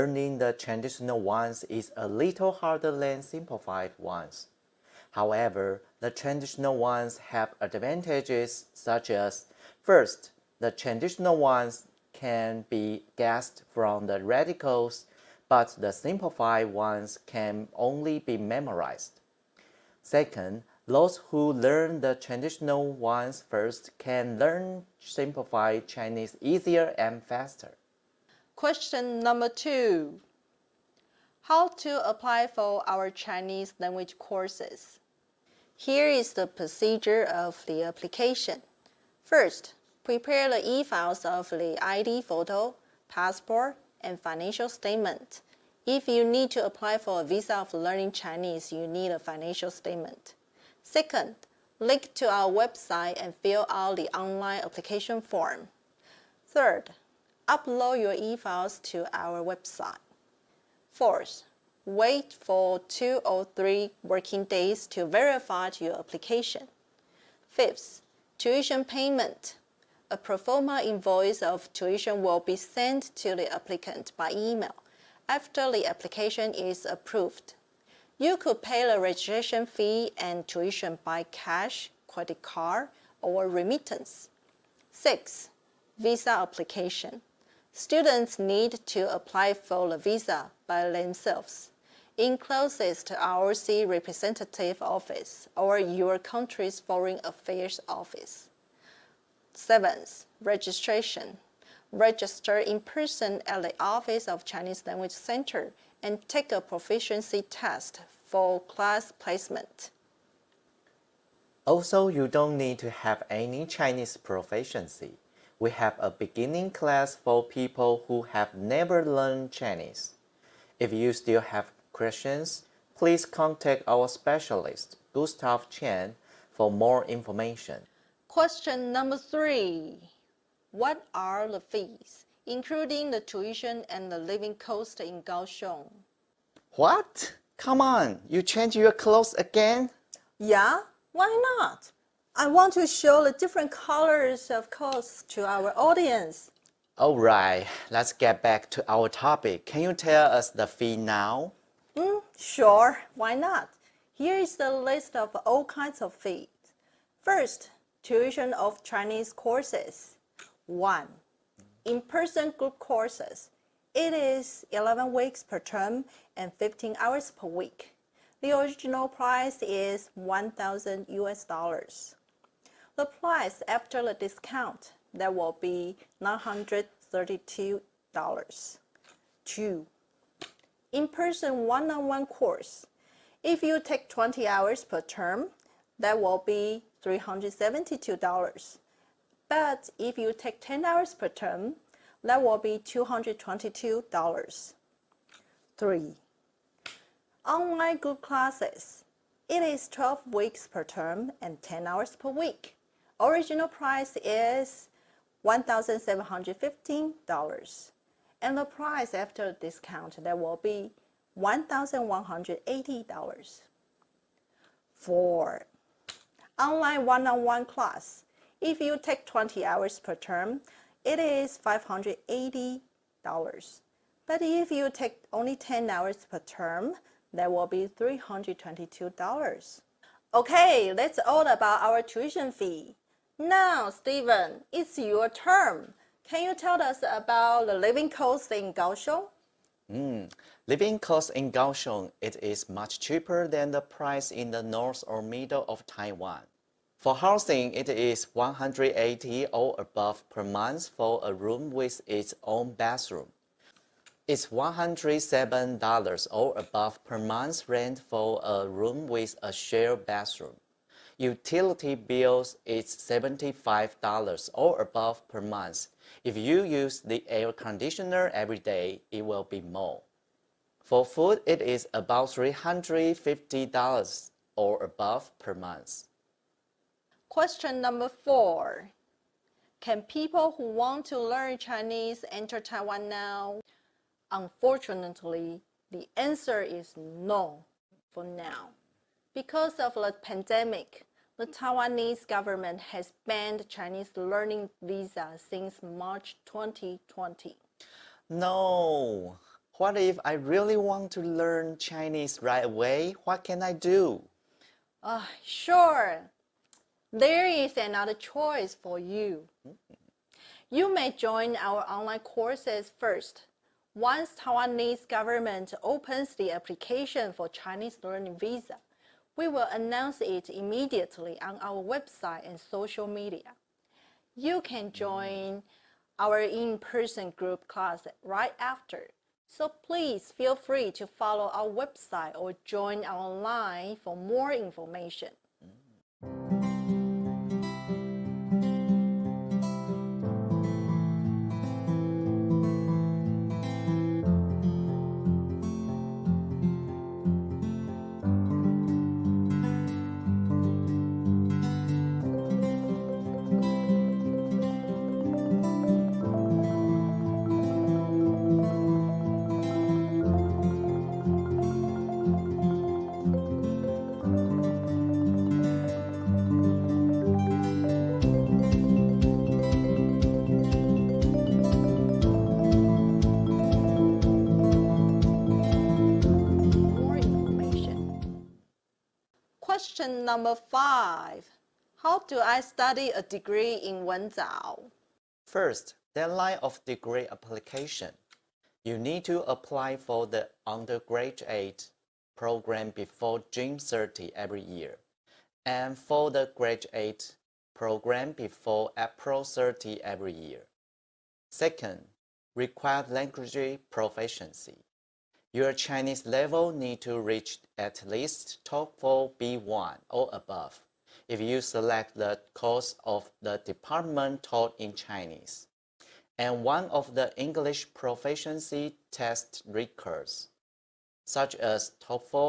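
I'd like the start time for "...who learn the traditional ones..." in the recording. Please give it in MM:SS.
00:21.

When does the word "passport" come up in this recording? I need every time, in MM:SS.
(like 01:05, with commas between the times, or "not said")
00:43.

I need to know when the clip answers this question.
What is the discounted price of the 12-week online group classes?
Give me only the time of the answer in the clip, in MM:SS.
03:31.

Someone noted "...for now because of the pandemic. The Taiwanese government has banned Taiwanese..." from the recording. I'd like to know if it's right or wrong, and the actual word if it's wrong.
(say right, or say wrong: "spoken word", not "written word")
wrong: "Chinese", not "Taiwanese".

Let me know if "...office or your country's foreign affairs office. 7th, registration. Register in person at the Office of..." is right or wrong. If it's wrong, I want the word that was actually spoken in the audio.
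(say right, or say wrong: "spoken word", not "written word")
right.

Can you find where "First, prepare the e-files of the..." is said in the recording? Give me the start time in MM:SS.
00:39.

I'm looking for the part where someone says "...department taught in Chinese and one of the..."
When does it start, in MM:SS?
06:53.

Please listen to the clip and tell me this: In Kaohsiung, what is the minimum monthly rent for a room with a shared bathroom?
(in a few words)
$107.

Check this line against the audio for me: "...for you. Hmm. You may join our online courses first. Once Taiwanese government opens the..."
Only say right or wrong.
right.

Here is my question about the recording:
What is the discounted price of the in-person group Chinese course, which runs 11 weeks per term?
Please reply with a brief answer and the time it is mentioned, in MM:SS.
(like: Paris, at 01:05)
$932, at 02:56.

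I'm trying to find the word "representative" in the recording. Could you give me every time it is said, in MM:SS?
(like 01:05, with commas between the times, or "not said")
01:33.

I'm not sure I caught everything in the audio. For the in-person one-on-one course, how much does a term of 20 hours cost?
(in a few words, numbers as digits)
$372.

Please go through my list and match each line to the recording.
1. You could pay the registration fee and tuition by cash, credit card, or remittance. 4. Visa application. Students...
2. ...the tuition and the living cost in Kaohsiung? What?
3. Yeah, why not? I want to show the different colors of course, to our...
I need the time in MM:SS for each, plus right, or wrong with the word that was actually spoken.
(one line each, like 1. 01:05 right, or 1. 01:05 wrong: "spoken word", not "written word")
1. 01:18 wrong: "6", not "4"
2. 02:13 right
3. 02:20 right.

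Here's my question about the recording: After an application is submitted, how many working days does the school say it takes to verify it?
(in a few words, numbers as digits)
2 or 3.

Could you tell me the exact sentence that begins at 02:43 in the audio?
It is 11 weeks per term and 15 hours per week.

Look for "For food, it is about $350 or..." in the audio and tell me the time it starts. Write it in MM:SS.
04:30.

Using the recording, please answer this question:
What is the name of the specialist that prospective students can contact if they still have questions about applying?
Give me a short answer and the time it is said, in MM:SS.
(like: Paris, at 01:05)
Gustav Chen, at 02:05.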